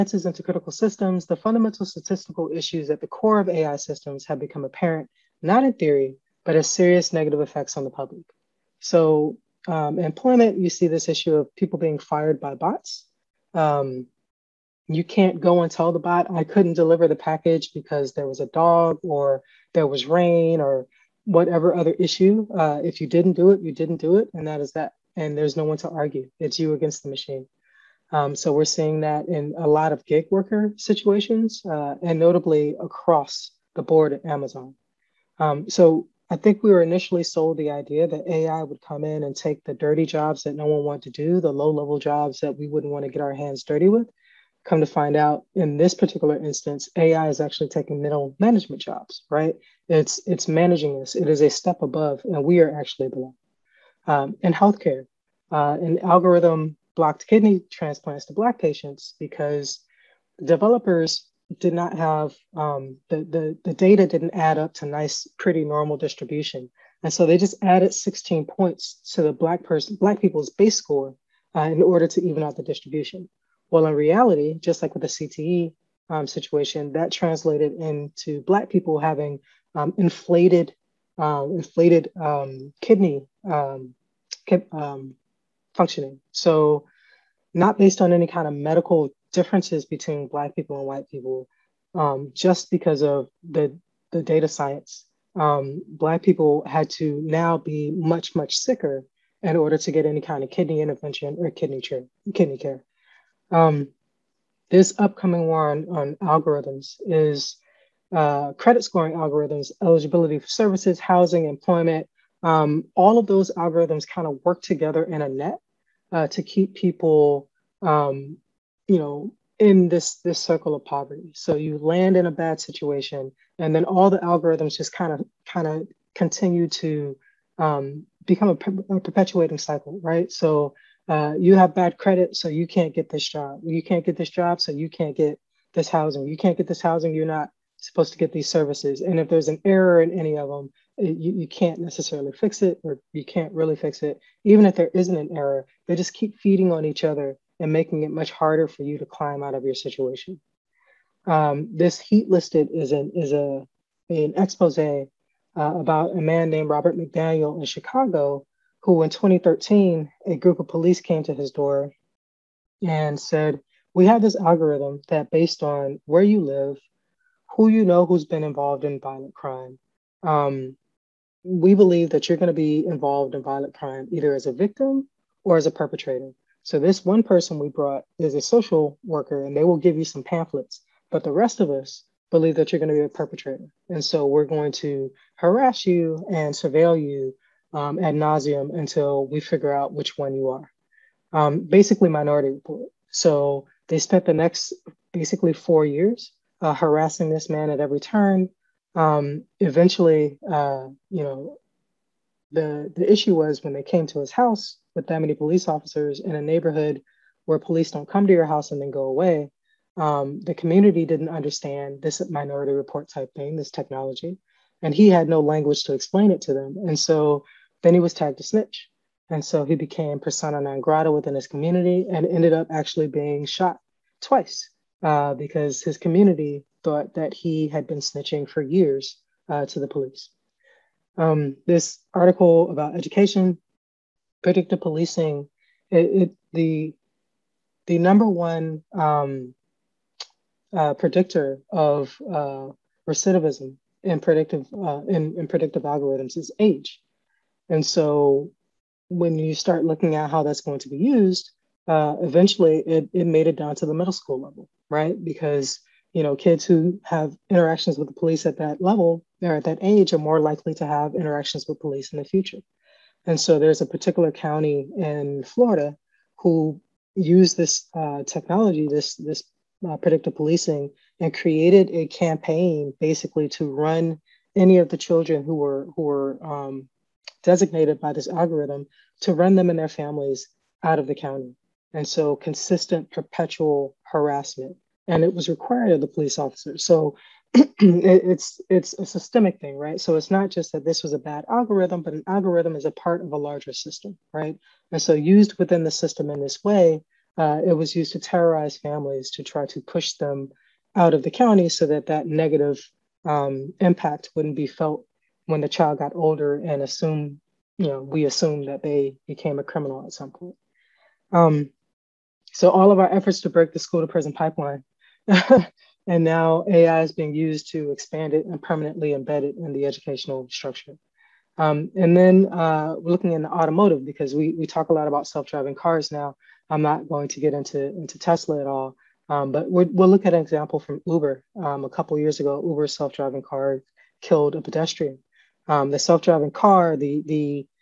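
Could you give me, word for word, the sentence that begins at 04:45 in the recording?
And it was required of the police officers.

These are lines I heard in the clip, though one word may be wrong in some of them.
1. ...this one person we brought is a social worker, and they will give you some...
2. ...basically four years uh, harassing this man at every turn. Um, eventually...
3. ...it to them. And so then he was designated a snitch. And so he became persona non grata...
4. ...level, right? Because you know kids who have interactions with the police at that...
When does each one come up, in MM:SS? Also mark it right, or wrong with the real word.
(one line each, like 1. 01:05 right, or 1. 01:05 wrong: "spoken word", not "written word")
1. 02:56 right
2. 03:15 right
3. 03:36 wrong: "tagged", not "designated"
4. 04:14 right.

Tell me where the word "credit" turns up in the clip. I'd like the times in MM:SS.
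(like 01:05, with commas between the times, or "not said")
01:48, 02:11.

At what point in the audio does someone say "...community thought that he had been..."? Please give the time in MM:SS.
03:45.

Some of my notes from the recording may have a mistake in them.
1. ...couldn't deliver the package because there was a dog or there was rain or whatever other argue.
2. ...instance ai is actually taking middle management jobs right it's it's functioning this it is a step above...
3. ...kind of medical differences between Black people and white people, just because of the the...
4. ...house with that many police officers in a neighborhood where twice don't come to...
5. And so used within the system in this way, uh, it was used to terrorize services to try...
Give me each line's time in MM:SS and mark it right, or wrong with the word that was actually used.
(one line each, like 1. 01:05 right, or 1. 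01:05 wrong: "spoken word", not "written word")
1. 00:16 wrong: "issue", not "argue"
2. 00:46 wrong: "managing", not "functioning"
3. 01:28 right
4. 03:24 wrong: "police", not "twice"
5. 04:54 wrong: "families", not "services".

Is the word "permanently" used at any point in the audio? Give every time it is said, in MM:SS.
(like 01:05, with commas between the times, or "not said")
05:18.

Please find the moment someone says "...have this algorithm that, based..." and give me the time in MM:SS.
02:44.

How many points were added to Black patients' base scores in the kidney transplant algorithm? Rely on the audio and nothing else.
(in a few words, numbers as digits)
16.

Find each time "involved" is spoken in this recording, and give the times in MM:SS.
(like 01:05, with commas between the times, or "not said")
02:48, 02:52.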